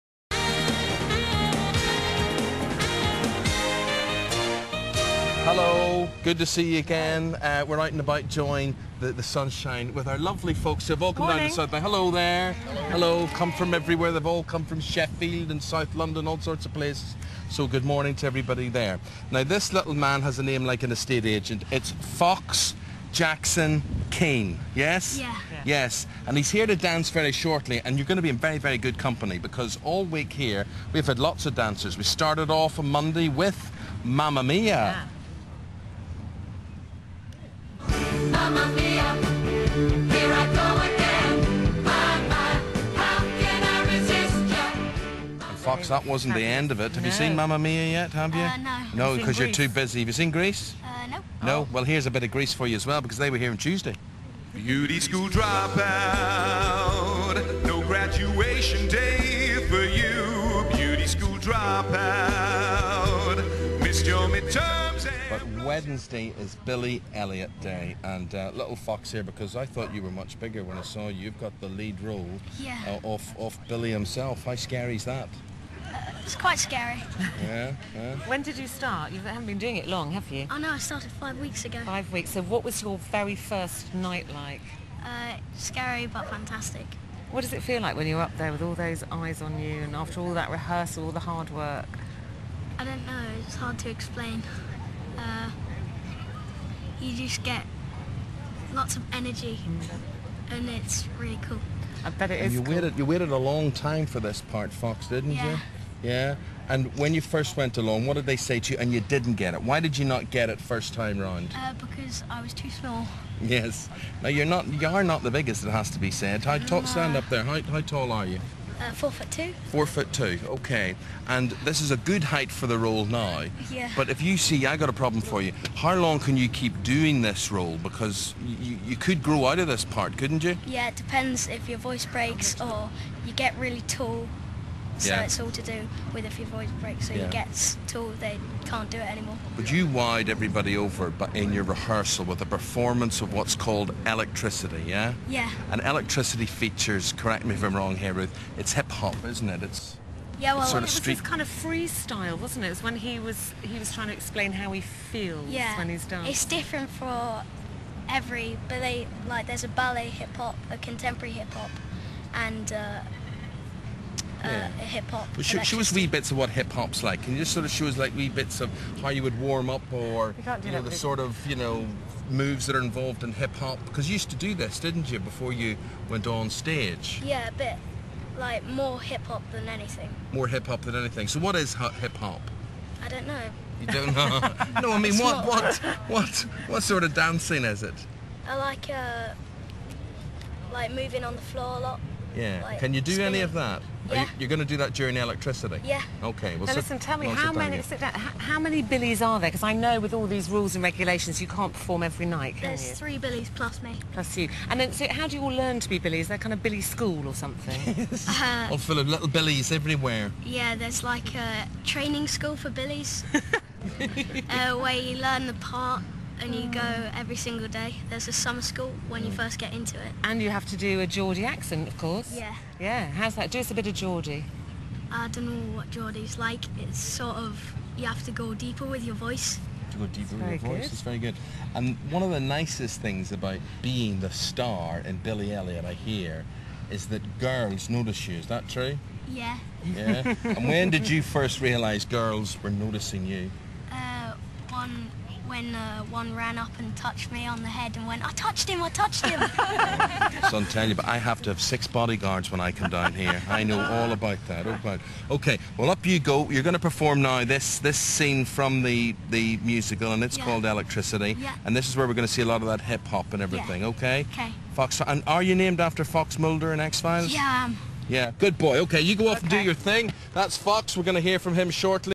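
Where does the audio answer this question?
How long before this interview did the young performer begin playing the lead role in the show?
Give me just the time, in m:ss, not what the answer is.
1:21.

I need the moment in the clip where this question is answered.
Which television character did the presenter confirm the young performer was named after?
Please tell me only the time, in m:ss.
4:26.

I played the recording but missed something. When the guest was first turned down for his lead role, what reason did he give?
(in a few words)
Too small.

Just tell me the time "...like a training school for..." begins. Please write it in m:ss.
3:31.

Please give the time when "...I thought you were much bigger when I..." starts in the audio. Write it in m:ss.
1:09.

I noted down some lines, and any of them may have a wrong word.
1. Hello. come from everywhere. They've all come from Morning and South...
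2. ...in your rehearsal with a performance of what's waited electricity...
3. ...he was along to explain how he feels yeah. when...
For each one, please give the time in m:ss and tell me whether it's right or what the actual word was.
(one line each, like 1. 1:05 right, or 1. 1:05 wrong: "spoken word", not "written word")
1. 0:12 wrong: "Sheffield", not "Morning"
2. 2:21 wrong: "called", not "waited"
3. 2:33 wrong: "trying", not "along".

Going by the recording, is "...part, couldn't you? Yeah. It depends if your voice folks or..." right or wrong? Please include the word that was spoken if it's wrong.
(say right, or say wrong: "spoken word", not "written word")
wrong: "breaks", not "folks".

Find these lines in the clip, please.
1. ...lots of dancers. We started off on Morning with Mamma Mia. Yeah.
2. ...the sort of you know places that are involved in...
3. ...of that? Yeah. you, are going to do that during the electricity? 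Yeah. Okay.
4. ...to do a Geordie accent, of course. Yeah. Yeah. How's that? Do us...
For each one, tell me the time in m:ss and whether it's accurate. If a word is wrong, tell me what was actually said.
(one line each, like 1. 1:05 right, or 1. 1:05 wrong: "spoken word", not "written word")
1. 0:31 wrong: "Monday", not "Morning"
2. 2:50 wrong: "moves", not "places"
3. 3:13 right
4. 3:40 right.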